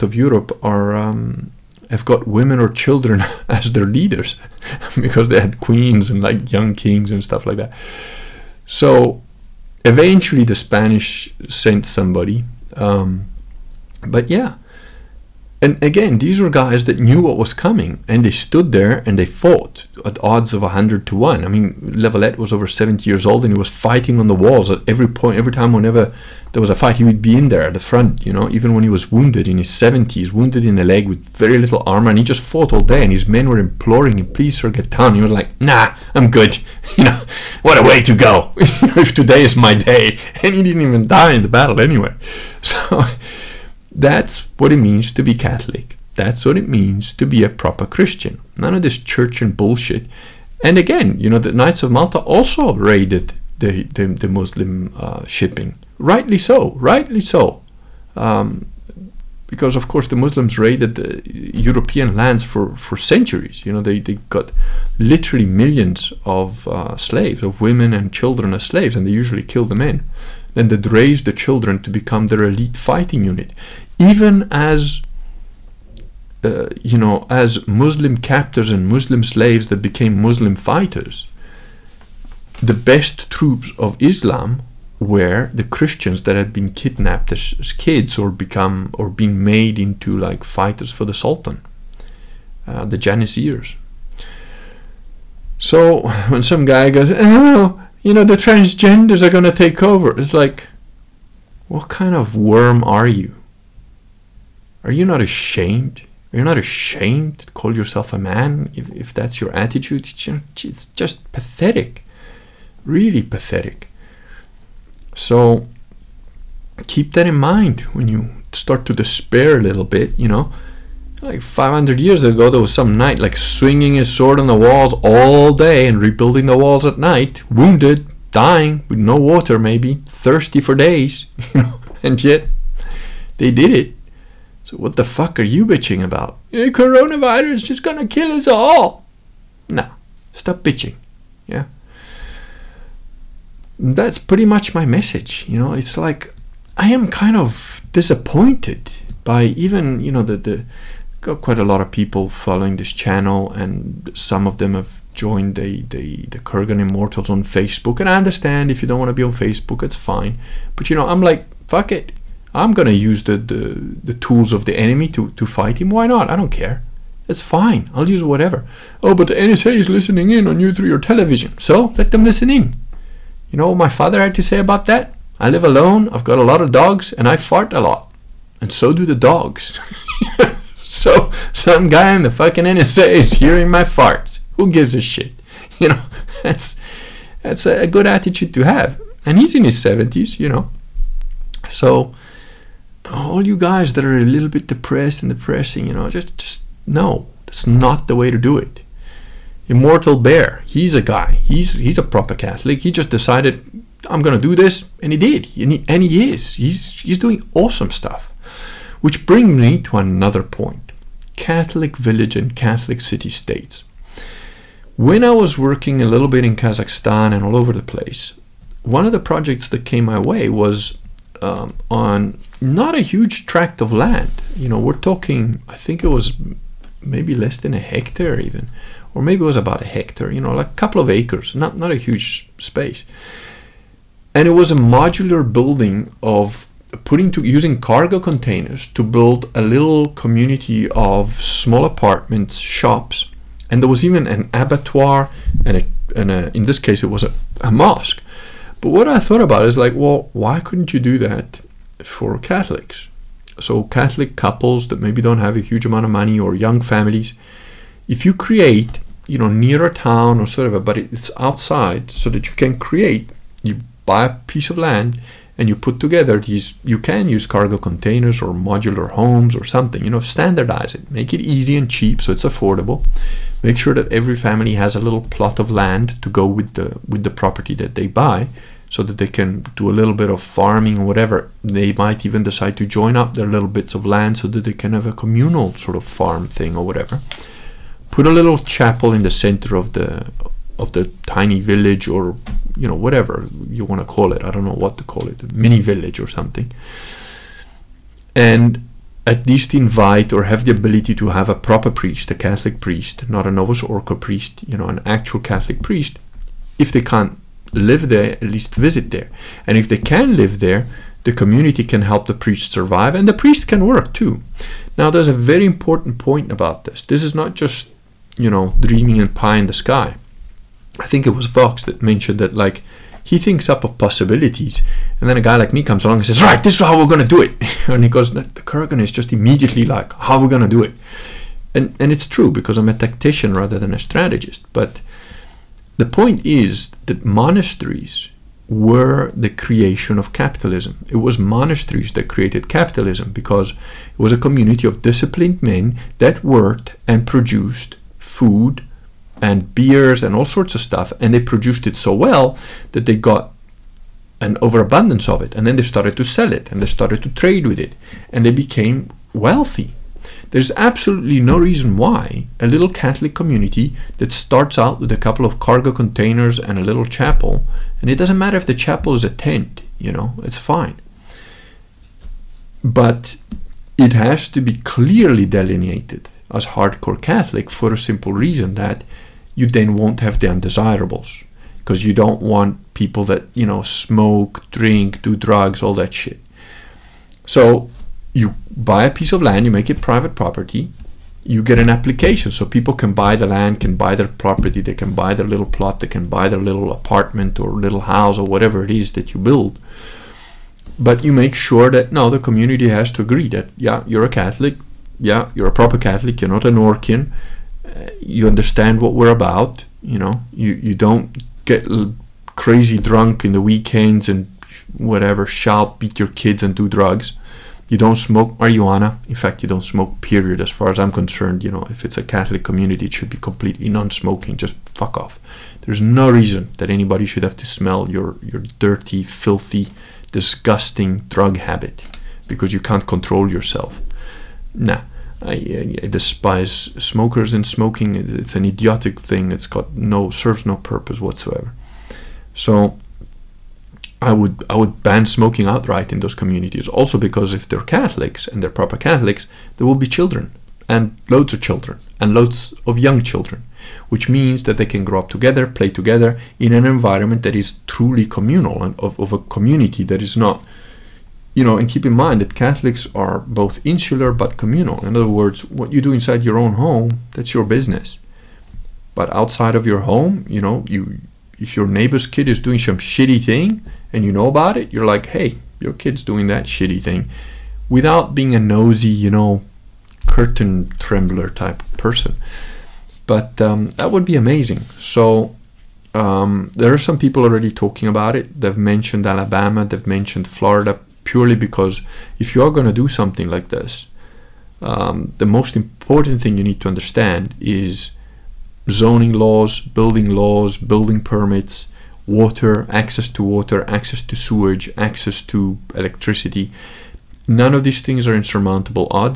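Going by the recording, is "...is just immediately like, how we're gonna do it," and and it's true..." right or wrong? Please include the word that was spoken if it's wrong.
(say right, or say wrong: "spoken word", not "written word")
right.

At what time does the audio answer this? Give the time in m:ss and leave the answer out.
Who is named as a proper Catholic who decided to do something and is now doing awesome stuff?
3:19.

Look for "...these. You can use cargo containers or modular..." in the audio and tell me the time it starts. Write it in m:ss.
4:26.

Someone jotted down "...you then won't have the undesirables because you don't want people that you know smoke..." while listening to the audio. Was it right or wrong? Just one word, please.
right.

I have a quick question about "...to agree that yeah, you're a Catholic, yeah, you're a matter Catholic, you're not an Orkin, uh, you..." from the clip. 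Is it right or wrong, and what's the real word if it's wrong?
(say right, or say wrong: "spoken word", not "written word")
wrong: "proper", not "matter".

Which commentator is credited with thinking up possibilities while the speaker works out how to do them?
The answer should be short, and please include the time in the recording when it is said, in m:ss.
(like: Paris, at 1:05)
Vox, at 5:21.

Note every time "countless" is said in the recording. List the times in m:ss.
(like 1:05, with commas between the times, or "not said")
not said.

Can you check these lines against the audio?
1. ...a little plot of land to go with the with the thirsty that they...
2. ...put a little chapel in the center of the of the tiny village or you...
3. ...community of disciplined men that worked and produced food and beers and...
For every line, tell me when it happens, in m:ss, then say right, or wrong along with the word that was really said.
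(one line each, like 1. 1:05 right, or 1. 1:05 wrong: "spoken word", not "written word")
1. 4:34 wrong: "property", not "thirsty"
2. 4:48 right
3. 5:44 right.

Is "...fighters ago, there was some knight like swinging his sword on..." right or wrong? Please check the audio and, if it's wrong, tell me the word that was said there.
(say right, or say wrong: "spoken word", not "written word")
wrong: "years", not "fighters".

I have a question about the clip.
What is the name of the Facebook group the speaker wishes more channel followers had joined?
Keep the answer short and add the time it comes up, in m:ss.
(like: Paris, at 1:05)
Kurgan Immortals, at 2:36.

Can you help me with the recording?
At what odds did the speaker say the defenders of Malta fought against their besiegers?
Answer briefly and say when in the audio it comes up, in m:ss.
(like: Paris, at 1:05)
100 to 1, at 0:20.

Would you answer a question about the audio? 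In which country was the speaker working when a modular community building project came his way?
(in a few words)
Kazakhstan.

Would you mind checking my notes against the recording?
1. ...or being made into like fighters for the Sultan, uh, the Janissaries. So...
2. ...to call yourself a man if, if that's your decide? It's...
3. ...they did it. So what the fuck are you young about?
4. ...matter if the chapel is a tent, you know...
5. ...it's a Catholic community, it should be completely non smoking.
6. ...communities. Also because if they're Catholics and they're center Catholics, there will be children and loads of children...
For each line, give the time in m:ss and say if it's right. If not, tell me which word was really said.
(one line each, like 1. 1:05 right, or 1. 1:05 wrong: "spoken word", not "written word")
1. 1:28 right
2. 1:47 wrong: "attitude", not "decide"
3. 2:13 wrong: "bitching", not "young"
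4. 6:08 right
5. 7:02 right
6. 7:26 wrong: "proper", not "center".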